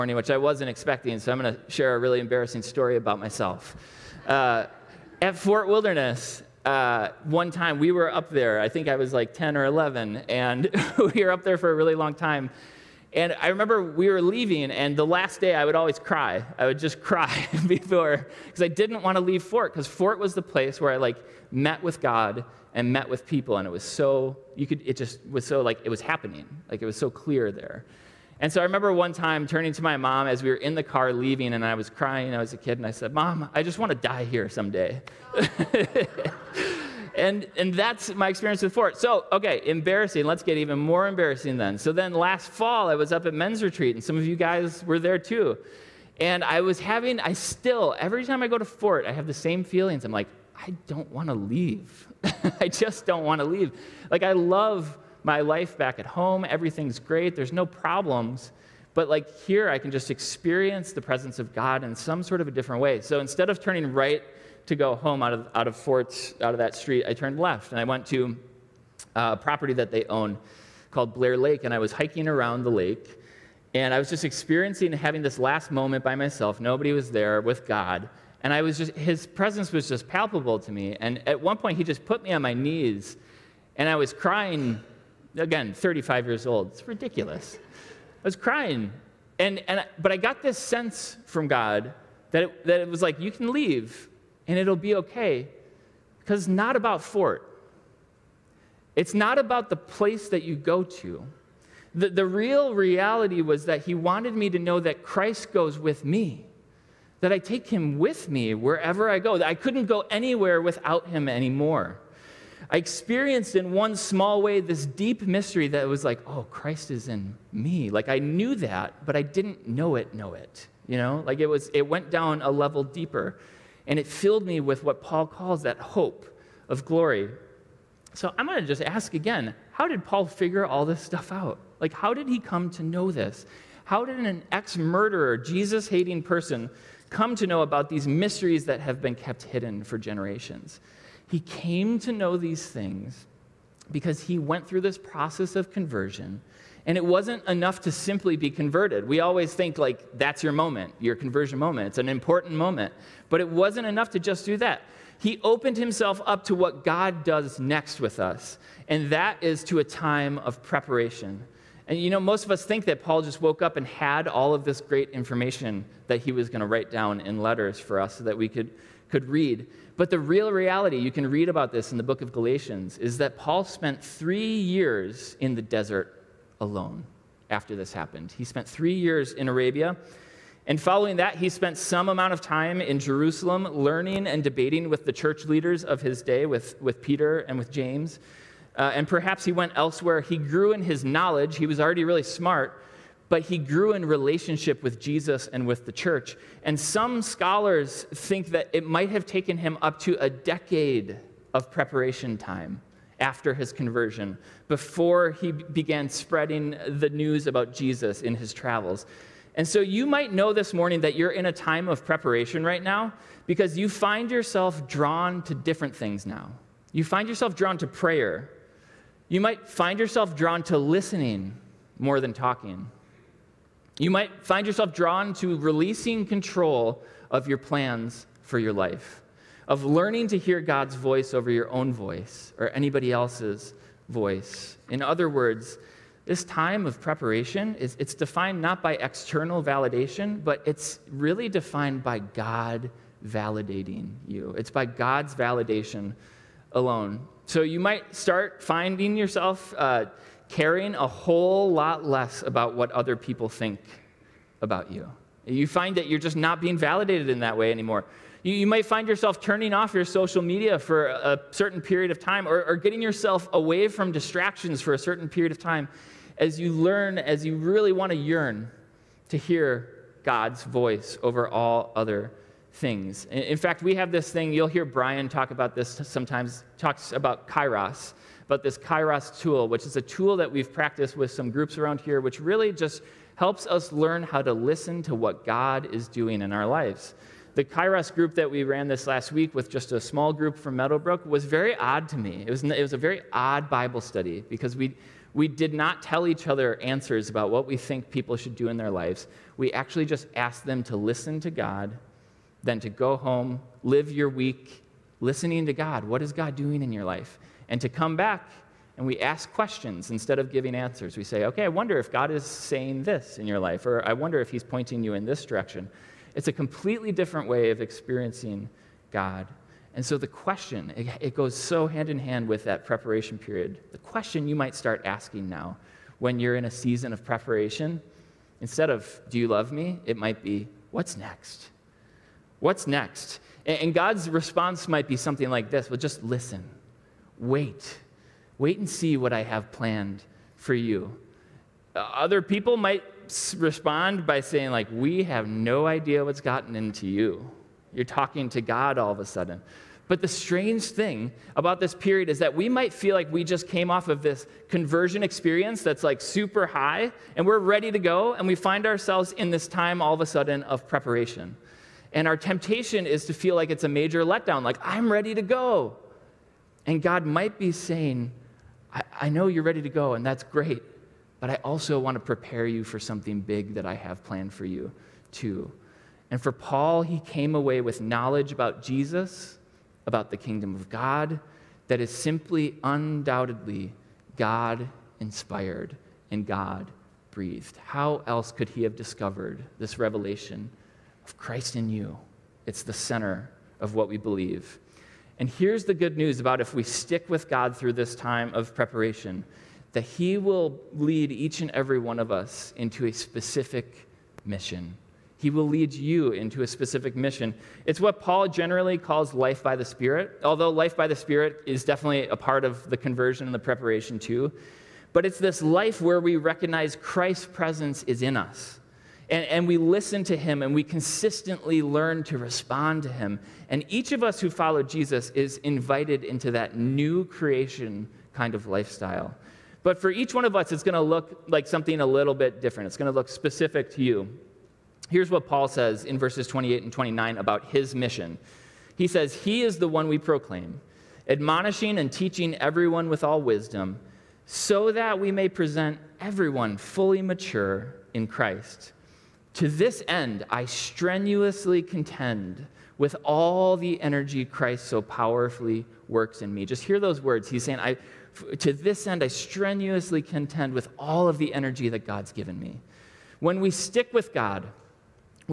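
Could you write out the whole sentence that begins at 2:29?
We always think, like, that's your moment, your conversion moment.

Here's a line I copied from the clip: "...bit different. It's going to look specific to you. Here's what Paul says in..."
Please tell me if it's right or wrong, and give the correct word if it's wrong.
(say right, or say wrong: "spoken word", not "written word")
right.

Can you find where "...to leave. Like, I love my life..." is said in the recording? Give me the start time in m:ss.
0:53.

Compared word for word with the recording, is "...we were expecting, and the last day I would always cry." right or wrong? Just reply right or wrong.
wrong.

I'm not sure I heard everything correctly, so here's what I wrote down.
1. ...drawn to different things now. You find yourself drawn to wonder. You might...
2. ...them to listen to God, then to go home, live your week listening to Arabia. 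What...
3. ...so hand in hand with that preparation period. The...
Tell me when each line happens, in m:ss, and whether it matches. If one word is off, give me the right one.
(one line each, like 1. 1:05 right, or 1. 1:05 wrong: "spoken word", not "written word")
1. 3:34 wrong: "prayer", not "wonder"
2. 5:00 wrong: "God", not "Arabia"
3. 5:21 right.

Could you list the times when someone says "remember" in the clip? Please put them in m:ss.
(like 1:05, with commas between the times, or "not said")
0:13, 0:28.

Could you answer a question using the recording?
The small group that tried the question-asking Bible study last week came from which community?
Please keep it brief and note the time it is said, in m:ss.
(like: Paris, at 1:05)
Meadowbrook, at 4:50.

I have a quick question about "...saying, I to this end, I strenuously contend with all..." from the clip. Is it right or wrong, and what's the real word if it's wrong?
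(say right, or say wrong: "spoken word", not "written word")
right.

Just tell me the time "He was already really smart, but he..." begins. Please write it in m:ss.
3:11.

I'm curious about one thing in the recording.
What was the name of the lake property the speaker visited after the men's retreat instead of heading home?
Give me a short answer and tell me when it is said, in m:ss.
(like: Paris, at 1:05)
Blair Lake, at 1:11.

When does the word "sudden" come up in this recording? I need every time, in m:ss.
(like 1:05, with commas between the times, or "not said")
5:49, 6:00.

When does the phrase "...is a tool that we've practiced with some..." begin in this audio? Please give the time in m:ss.
4:39.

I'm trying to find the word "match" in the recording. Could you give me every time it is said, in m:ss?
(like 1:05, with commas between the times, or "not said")
not said.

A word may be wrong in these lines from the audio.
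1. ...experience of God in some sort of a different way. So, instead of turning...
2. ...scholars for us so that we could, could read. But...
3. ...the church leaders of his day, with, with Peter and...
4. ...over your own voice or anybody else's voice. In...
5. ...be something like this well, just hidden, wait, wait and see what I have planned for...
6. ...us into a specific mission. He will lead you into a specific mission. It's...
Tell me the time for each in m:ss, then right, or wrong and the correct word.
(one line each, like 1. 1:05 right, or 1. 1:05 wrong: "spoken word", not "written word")
1. 1:01 wrong: "presence", not "experience"
2. 2:47 wrong: "letters", not "scholars"
3. 3:05 right
4. 3:51 right
5. 5:35 wrong: "listen", not "hidden"
6. 6:42 right.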